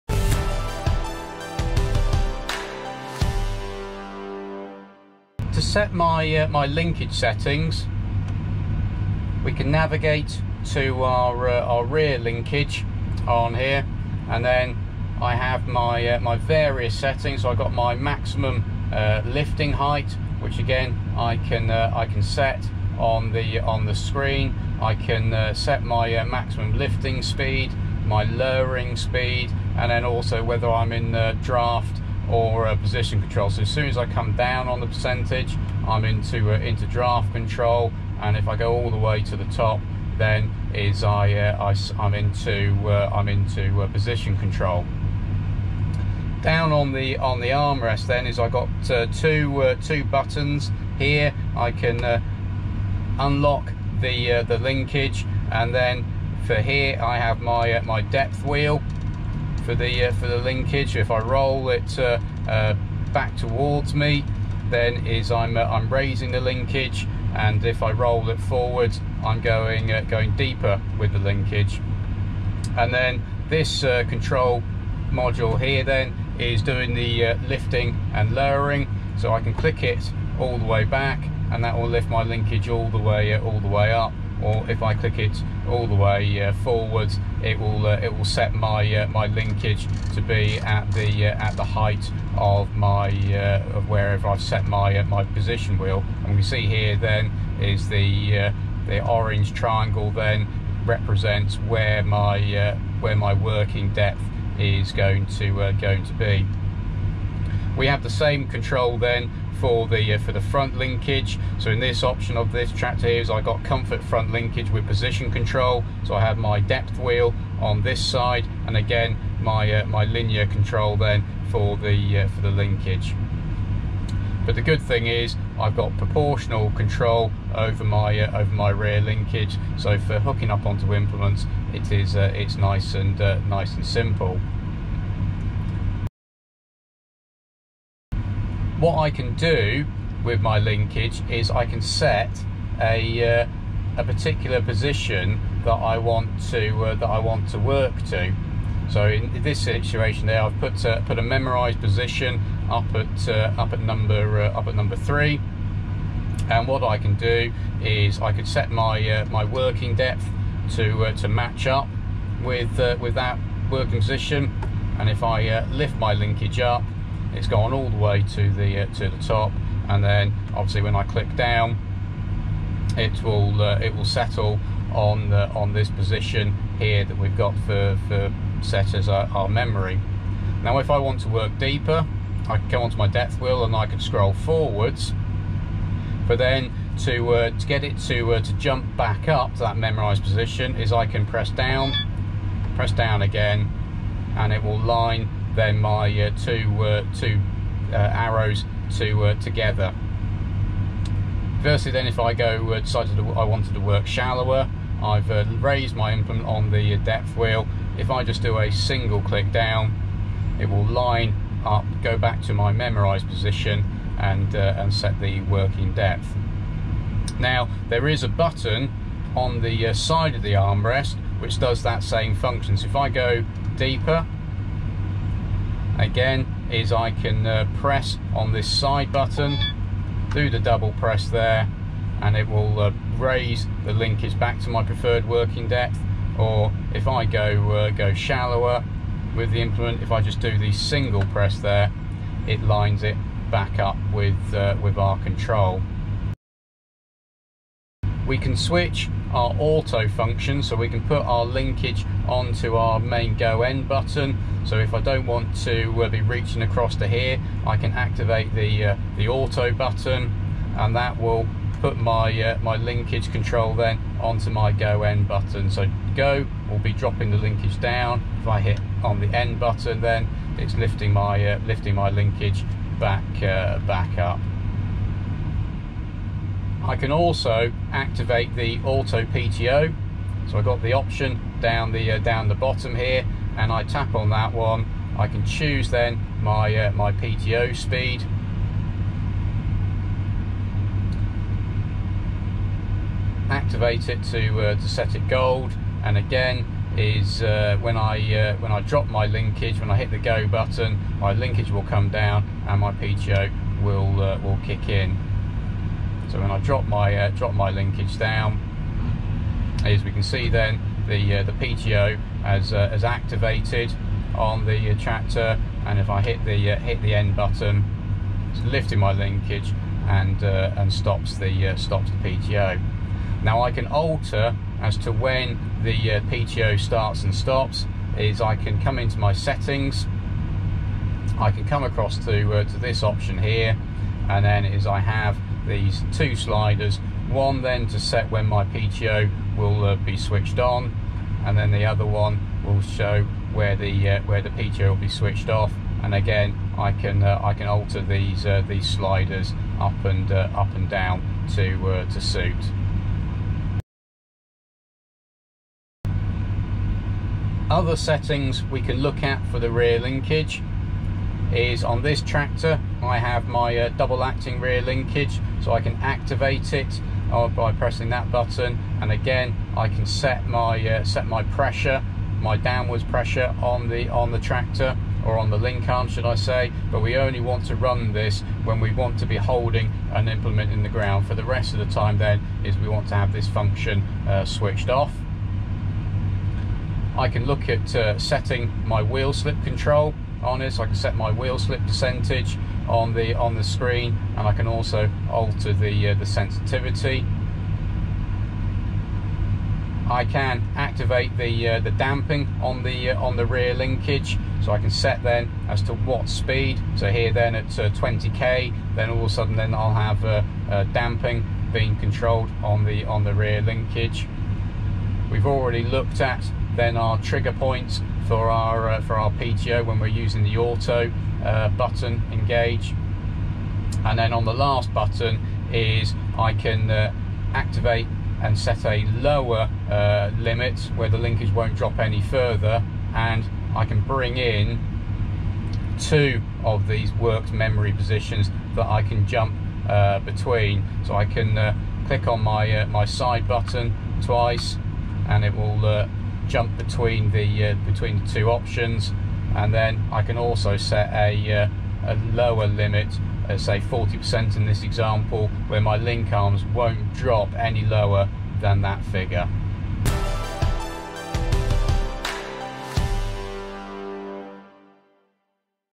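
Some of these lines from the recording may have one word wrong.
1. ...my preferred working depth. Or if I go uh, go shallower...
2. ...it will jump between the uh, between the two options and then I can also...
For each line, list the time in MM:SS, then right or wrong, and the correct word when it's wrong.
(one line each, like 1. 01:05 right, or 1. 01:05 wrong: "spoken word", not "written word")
1. 03:54 right
2. 07:25 right.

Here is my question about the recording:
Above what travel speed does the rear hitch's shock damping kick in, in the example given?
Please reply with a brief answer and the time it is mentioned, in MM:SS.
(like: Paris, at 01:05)
20k, at 06:47.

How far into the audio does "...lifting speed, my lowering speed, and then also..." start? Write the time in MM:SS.
00:26.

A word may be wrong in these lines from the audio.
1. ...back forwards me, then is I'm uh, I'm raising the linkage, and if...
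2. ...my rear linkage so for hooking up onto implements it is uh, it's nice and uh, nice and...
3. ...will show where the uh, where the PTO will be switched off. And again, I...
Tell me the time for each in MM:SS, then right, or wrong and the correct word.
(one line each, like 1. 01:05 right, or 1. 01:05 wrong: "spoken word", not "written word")
1. 01:03 wrong: "towards", not "forwards"
2. 02:08 right
3. 05:42 right.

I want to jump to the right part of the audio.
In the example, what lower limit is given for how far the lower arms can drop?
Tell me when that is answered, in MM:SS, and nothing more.
07:33.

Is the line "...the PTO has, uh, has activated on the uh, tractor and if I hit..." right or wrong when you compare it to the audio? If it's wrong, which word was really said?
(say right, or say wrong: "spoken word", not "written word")
right.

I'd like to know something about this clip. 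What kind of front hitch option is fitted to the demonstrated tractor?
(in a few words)
comfort front linkage.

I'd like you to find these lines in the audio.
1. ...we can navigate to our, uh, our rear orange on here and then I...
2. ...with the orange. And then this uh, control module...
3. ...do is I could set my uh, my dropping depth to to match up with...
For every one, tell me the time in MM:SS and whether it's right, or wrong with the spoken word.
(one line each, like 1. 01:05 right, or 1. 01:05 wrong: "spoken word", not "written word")
1. 00:09 wrong: "linkage", not "orange"
2. 01:10 wrong: "linkage", not "orange"
3. 02:37 wrong: "working", not "dropping".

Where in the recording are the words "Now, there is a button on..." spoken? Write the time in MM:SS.
03:37.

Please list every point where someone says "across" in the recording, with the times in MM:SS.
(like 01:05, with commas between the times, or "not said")
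04:16, 05:31.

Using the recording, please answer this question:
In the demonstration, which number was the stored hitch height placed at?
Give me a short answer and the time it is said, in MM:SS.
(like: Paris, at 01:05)
3, at 02:33.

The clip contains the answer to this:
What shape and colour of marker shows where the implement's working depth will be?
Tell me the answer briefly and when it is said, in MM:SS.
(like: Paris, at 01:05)
orange triangle, at 01:39.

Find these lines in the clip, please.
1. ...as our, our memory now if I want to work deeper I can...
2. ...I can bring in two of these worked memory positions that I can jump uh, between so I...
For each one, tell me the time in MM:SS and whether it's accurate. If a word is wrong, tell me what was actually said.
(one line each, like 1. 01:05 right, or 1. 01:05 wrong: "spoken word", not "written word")
1. 02:58 right
2. 07:13 right.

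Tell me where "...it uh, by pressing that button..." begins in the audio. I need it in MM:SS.
06:06.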